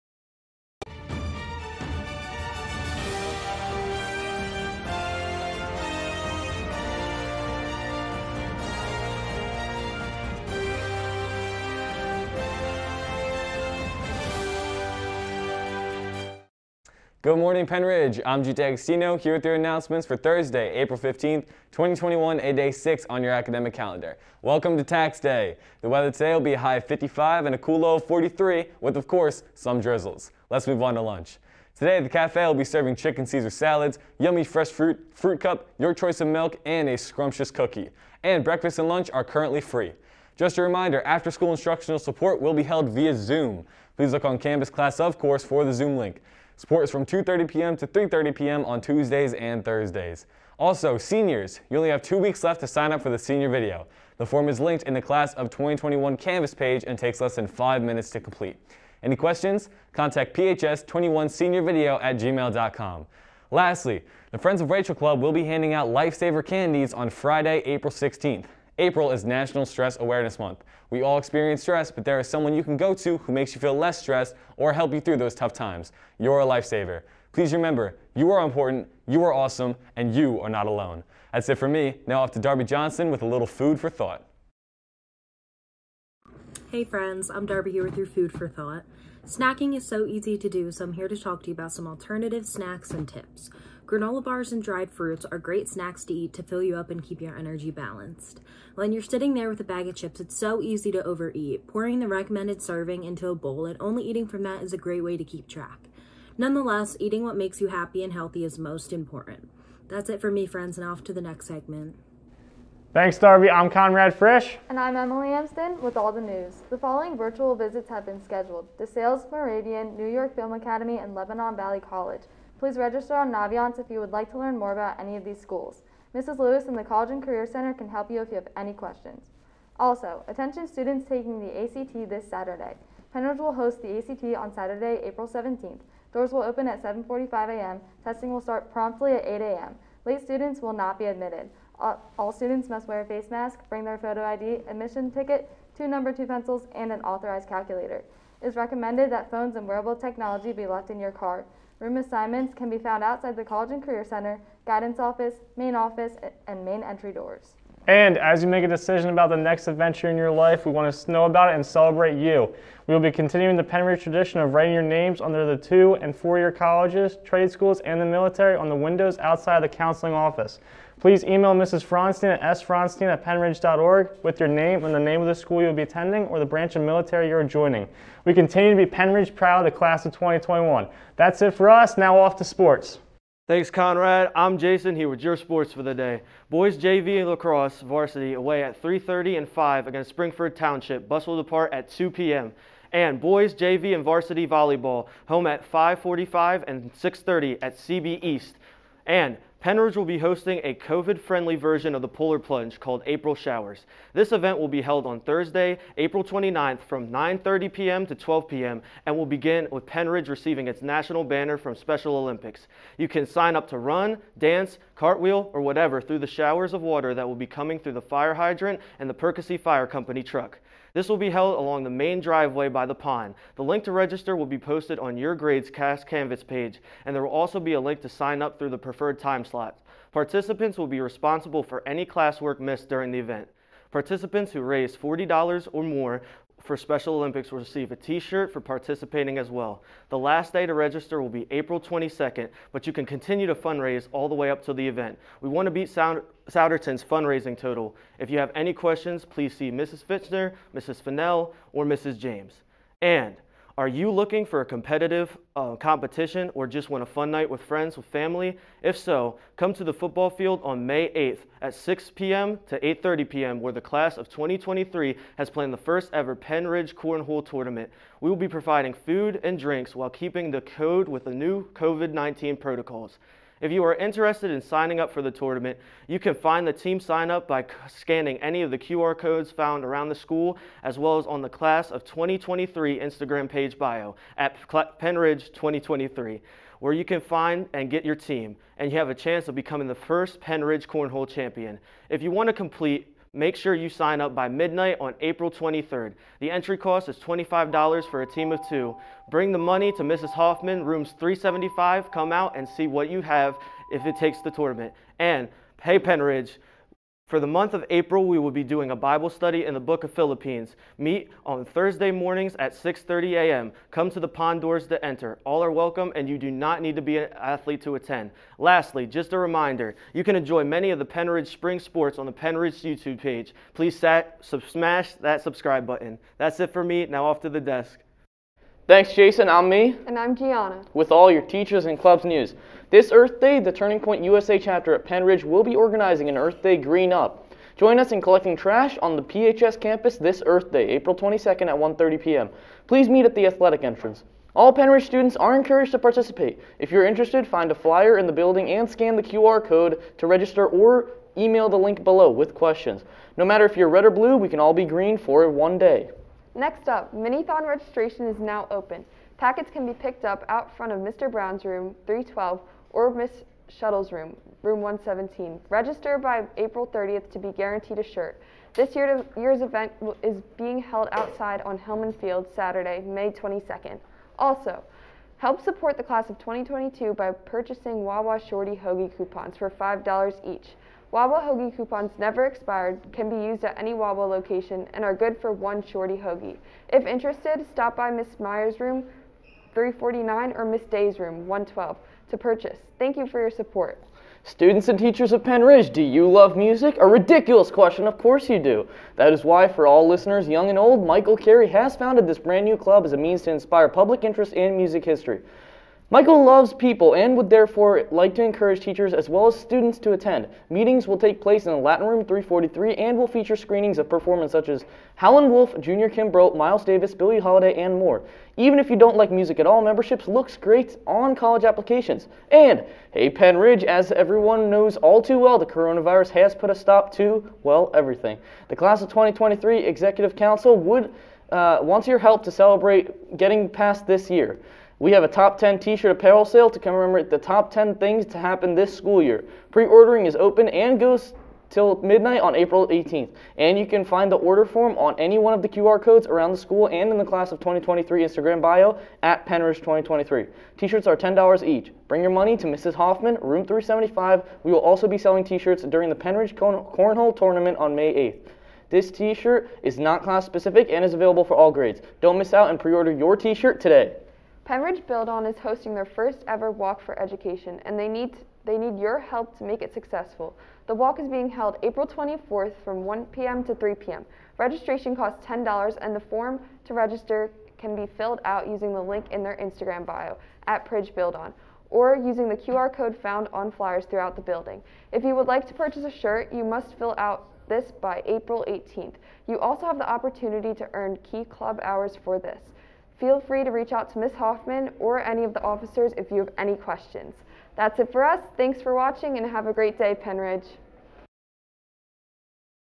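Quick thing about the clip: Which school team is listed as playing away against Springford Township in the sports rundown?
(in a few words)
Boys JV lacrosse.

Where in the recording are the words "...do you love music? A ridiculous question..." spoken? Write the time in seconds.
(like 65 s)
395 s.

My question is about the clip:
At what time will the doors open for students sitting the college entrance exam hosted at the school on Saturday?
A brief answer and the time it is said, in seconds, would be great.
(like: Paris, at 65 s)
7:45 a.m., at 136 s.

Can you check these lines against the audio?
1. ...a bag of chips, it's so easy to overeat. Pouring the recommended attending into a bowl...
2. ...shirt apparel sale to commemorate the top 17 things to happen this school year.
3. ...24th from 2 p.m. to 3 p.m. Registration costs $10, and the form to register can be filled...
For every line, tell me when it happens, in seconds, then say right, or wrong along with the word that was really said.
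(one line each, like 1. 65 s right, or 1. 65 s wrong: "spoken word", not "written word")
1. 99 s wrong: "serving", not "attending"
2. 435 s wrong: "10", not "17"
3. 472 s wrong: "1", not "2".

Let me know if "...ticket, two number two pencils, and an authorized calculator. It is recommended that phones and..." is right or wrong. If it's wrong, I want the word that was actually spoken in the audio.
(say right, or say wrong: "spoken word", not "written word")
right.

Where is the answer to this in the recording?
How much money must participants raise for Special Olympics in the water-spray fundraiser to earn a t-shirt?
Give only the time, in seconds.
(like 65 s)
234 s.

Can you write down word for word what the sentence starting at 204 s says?
This event will be held on Thursday, April 29th from 9.30 p.m.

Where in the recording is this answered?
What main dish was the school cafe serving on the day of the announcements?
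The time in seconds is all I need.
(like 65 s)
32 s.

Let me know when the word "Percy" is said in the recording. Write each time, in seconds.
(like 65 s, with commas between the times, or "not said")
219 s.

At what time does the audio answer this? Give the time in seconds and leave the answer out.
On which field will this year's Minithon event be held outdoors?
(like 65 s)
371 s.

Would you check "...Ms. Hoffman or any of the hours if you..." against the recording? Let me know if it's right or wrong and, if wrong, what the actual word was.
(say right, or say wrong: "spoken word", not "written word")
wrong: "officers", not "hours".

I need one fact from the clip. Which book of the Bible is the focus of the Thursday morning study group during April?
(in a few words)
Philippians.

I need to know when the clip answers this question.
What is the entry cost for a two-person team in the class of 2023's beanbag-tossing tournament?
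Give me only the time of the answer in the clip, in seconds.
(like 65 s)
297 s.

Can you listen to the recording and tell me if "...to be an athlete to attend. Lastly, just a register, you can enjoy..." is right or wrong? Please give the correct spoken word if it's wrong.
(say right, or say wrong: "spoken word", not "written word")
wrong: "reminder", not "register".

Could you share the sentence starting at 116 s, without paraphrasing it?
The following virtual visits have been scheduled DeSales Moravian, New York Film Academy, and Lebanon Valley College.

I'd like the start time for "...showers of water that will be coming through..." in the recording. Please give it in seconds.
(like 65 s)
216 s.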